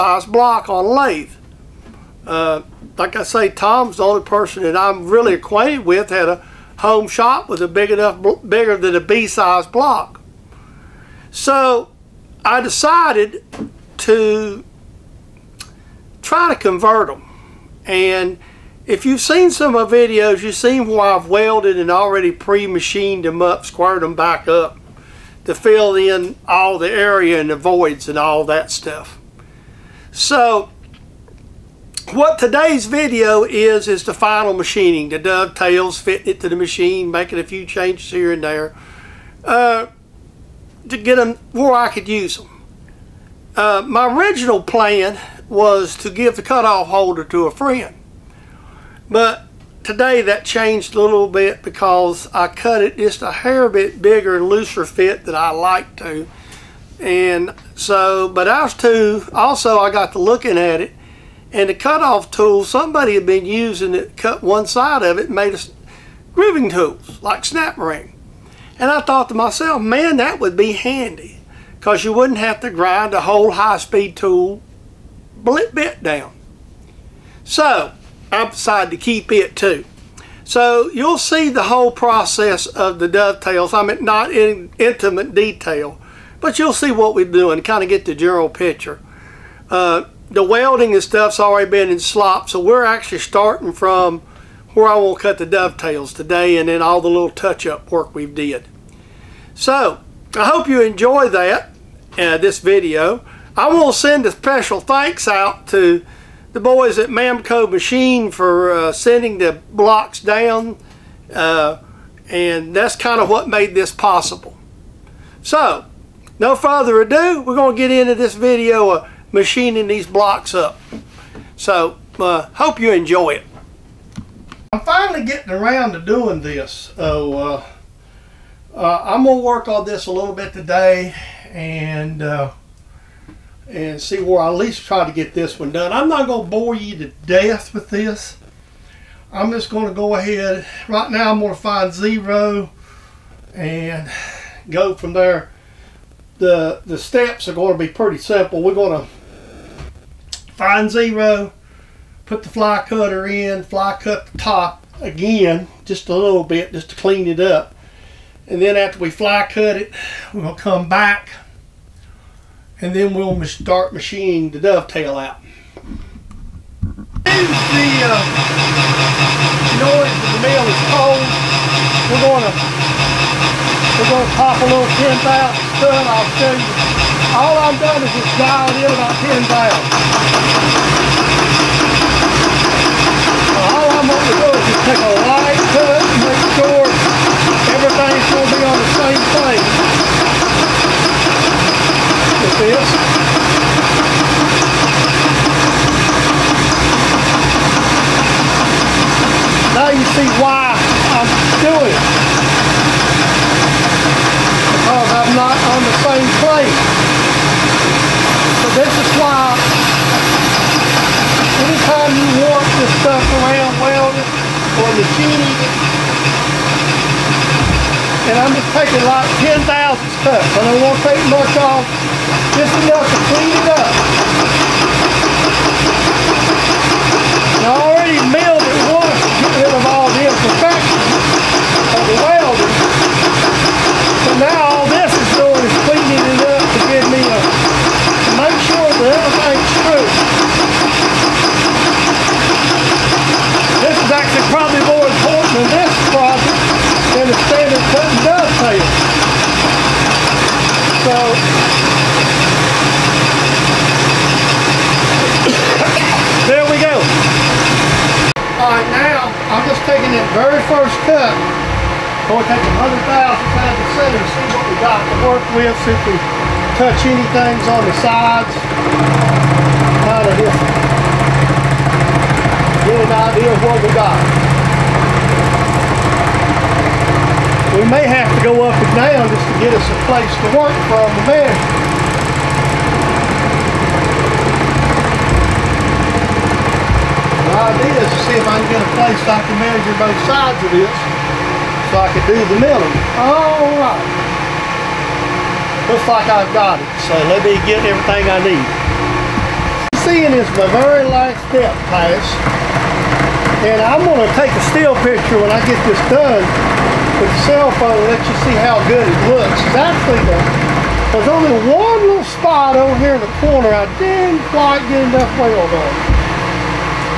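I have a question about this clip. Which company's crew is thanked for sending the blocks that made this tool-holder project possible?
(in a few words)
Mamco Machine.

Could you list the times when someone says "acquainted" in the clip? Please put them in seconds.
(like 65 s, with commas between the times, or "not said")
5 s.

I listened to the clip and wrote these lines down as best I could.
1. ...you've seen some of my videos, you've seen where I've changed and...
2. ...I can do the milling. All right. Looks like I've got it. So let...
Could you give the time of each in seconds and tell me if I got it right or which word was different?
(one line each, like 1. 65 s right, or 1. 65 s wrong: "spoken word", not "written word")
1. 19 s wrong: "welded", not "changed"
2. 291 s right.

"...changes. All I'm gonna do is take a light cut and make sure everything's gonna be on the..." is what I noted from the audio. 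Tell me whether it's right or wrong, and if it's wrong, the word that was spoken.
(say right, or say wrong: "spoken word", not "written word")
wrong: "valves", not "changes".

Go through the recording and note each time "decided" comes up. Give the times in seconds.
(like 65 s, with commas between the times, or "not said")
12 s, 78 s.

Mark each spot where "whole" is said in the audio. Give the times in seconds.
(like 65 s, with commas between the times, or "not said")
73 s, 81 s.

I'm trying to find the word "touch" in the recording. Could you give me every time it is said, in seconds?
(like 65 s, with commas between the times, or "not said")
97 s, 266 s.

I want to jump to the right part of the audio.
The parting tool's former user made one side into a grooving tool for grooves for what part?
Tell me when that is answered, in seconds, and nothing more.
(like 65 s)
67 s.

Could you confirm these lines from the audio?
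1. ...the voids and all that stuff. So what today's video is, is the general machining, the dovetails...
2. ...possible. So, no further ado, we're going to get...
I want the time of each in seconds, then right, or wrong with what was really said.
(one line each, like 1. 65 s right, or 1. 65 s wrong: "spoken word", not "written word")
1. 27 s wrong: "final", not "general"
2. 113 s right.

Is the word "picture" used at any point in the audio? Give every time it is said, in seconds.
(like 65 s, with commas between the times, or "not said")
88 s, 305 s.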